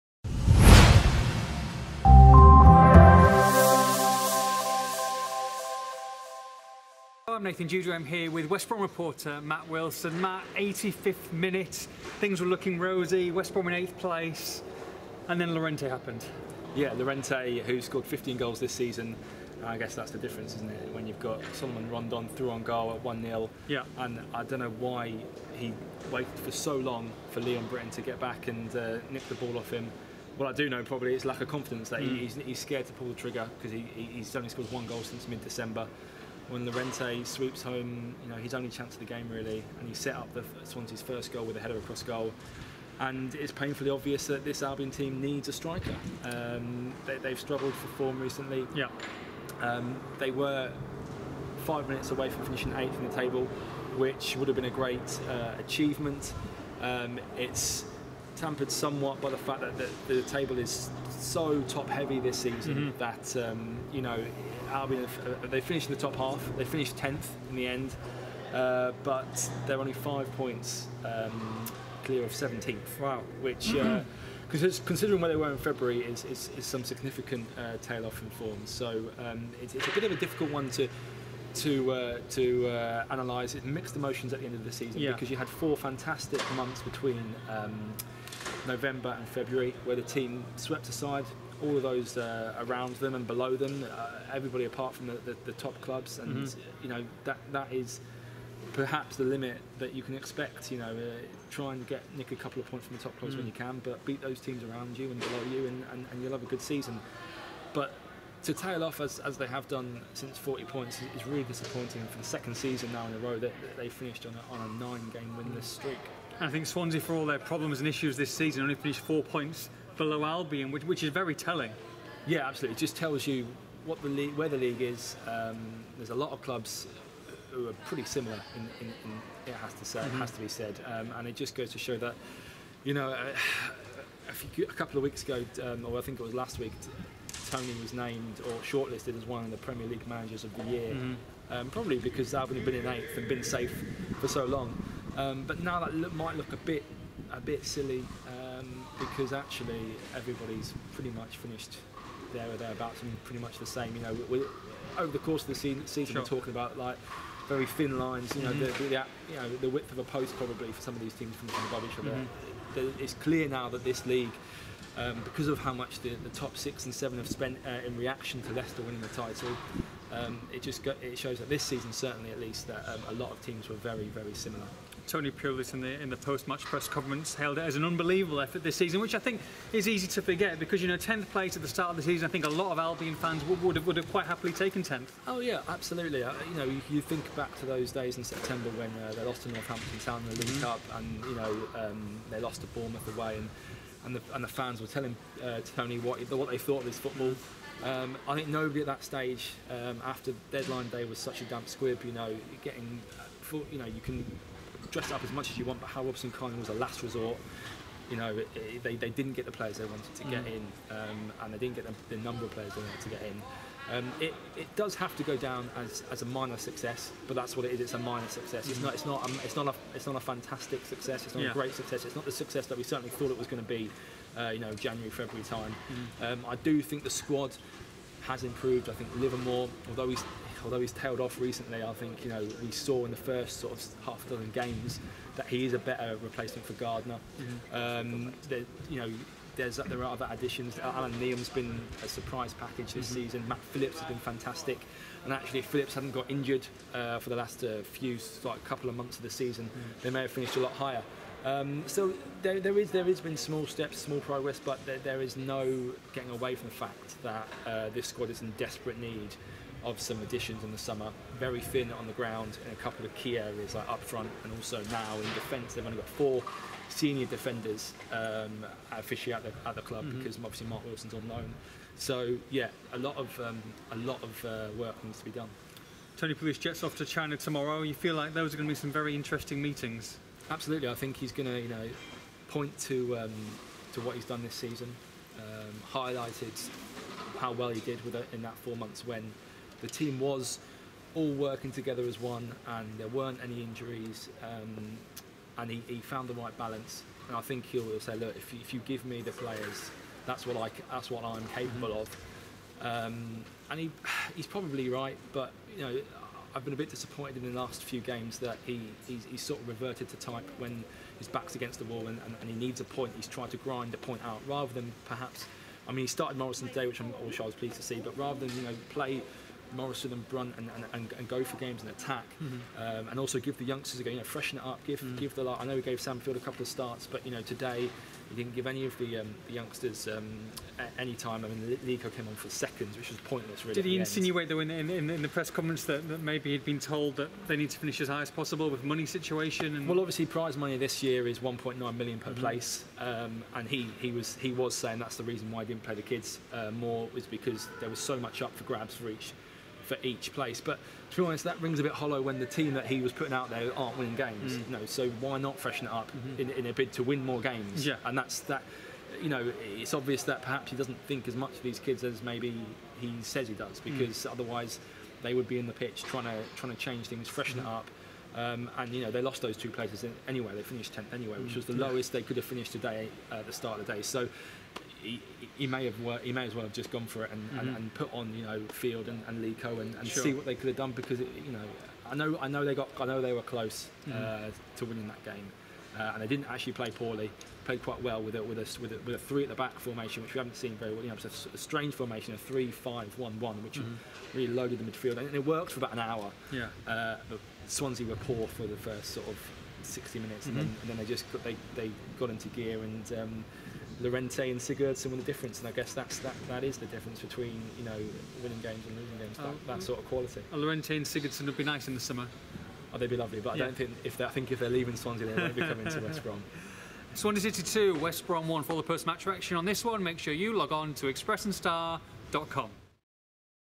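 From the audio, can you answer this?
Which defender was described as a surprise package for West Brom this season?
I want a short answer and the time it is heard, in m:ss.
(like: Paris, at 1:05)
Allan Nyom, at 4:00.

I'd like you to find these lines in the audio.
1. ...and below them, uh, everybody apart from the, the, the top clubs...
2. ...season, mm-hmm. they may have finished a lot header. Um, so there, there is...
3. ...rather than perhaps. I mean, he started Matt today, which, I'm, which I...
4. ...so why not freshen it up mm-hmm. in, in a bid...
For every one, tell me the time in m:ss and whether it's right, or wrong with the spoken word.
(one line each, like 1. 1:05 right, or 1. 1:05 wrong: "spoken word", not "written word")
1. 1:33 right
2. 4:09 wrong: "higher", not "header"
3. 5:14 wrong: "Morrison", not "Matt"
4. 5:54 right.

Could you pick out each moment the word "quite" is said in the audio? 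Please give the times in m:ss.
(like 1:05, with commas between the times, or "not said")
3:04, 6:27.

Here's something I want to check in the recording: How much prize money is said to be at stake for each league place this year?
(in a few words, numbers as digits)
1.9 million.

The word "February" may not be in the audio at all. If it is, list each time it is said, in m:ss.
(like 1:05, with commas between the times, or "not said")
1:15, 1:29, 3:45.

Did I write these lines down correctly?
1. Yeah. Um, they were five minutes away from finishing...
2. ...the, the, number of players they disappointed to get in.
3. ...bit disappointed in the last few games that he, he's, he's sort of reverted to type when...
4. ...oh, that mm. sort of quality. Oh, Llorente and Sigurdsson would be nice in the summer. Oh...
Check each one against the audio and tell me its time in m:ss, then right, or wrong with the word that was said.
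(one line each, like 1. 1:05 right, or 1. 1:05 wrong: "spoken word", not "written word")
1. 0:48 right
2. 3:31 wrong: "wanted", not "disappointed"
3. 5:06 right
4. 6:49 right.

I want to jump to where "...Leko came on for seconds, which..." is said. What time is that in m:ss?
5:31.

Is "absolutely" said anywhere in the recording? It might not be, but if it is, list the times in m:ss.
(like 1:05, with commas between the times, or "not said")
2:02, 3:05, 4:40.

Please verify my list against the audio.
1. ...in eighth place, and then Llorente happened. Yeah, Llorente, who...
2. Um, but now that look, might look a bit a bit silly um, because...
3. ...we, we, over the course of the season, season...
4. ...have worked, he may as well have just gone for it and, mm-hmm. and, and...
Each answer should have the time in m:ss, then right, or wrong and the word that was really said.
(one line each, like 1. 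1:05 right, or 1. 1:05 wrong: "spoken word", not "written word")
1. 0:13 right
2. 2:25 right
3. 2:34 right
4. 6:15 right.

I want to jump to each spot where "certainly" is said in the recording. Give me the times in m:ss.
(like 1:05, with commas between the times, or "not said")
2:51, 3:42.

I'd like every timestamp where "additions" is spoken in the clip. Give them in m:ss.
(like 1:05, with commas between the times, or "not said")
4:00, 4:20.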